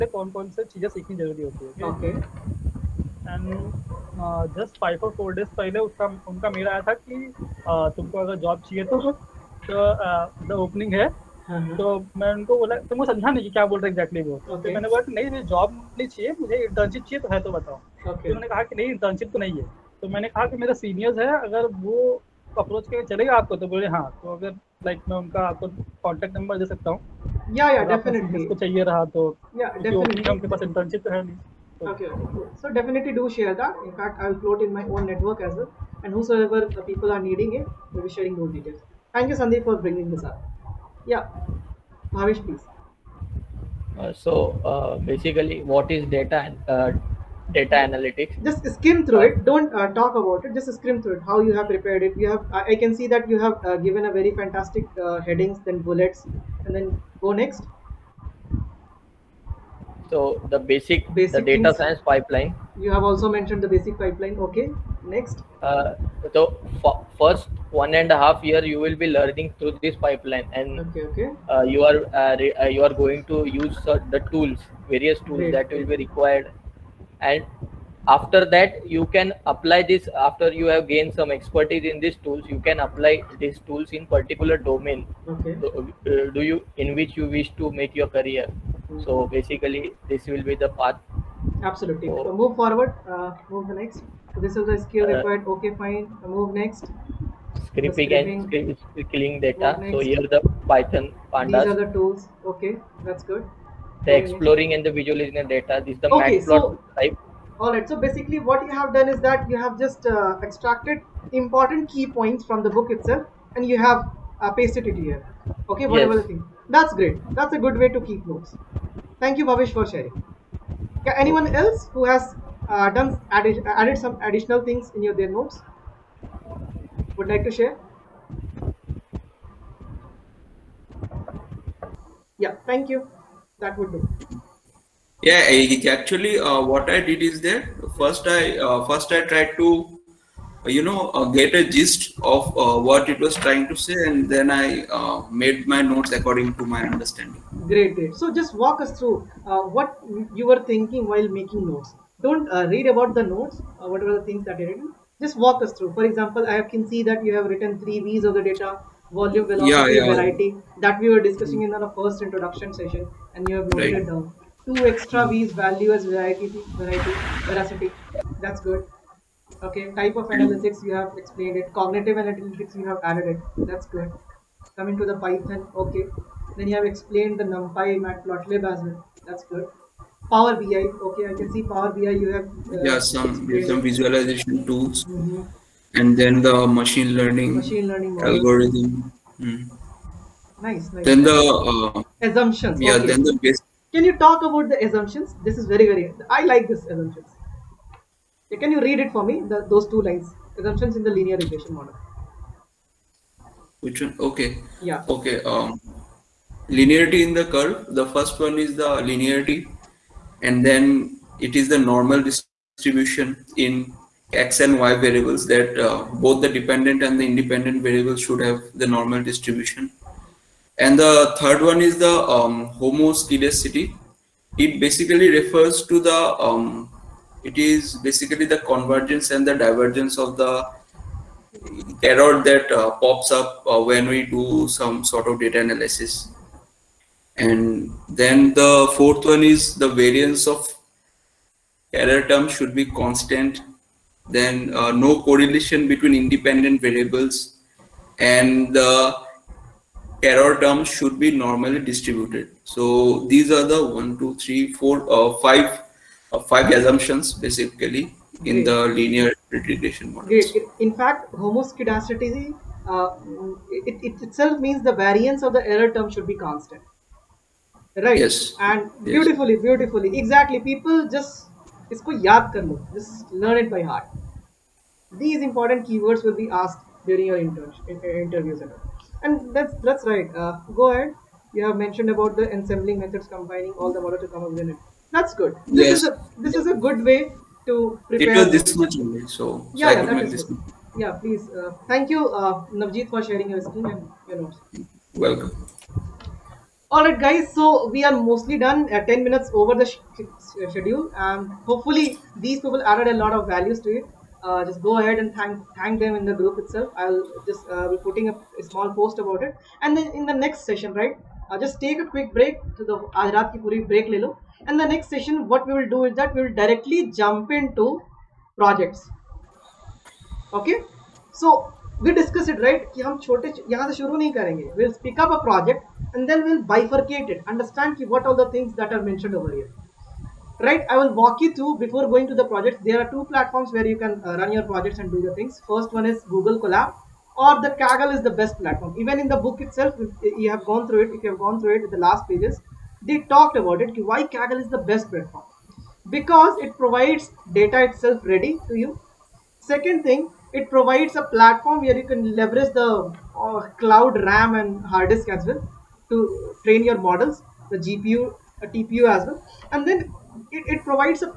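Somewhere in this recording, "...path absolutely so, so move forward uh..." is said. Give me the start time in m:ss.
1:30.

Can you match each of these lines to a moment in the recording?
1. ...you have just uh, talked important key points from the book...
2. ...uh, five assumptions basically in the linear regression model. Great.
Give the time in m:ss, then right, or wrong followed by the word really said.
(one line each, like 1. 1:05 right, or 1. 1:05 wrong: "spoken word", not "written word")
1. 1:49 wrong: "extracted", not "talked"
2. 4:16 right.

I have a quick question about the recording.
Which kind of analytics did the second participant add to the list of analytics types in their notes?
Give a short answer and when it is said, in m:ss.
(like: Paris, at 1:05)
Cognitive analytics, at 2:51.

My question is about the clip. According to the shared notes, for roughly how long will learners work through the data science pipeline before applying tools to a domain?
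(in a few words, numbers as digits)
1.5 years.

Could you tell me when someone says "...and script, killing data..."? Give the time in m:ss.
1:38.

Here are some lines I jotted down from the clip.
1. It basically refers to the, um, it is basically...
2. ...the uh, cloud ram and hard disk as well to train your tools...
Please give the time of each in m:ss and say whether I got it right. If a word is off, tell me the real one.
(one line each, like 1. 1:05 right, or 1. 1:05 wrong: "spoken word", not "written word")
1. 3:44 right
2. 5:52 wrong: "models", not "tools".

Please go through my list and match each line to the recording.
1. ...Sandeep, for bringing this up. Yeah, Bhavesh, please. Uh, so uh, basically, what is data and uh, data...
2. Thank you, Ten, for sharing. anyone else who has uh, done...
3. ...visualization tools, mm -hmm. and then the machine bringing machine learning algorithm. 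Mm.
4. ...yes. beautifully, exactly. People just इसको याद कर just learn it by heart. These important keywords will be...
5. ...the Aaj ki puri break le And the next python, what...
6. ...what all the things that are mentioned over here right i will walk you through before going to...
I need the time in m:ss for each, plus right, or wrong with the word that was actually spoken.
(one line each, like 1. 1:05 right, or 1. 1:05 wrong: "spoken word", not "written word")
1. 0:39 right
2. 1:59 wrong: "Bhavesh", not "Ten"
3. 3:03 wrong: "learning", not "bringing"
4. 4:29 right
5. 5:12 wrong: "session", not "python"
6. 5:28 right.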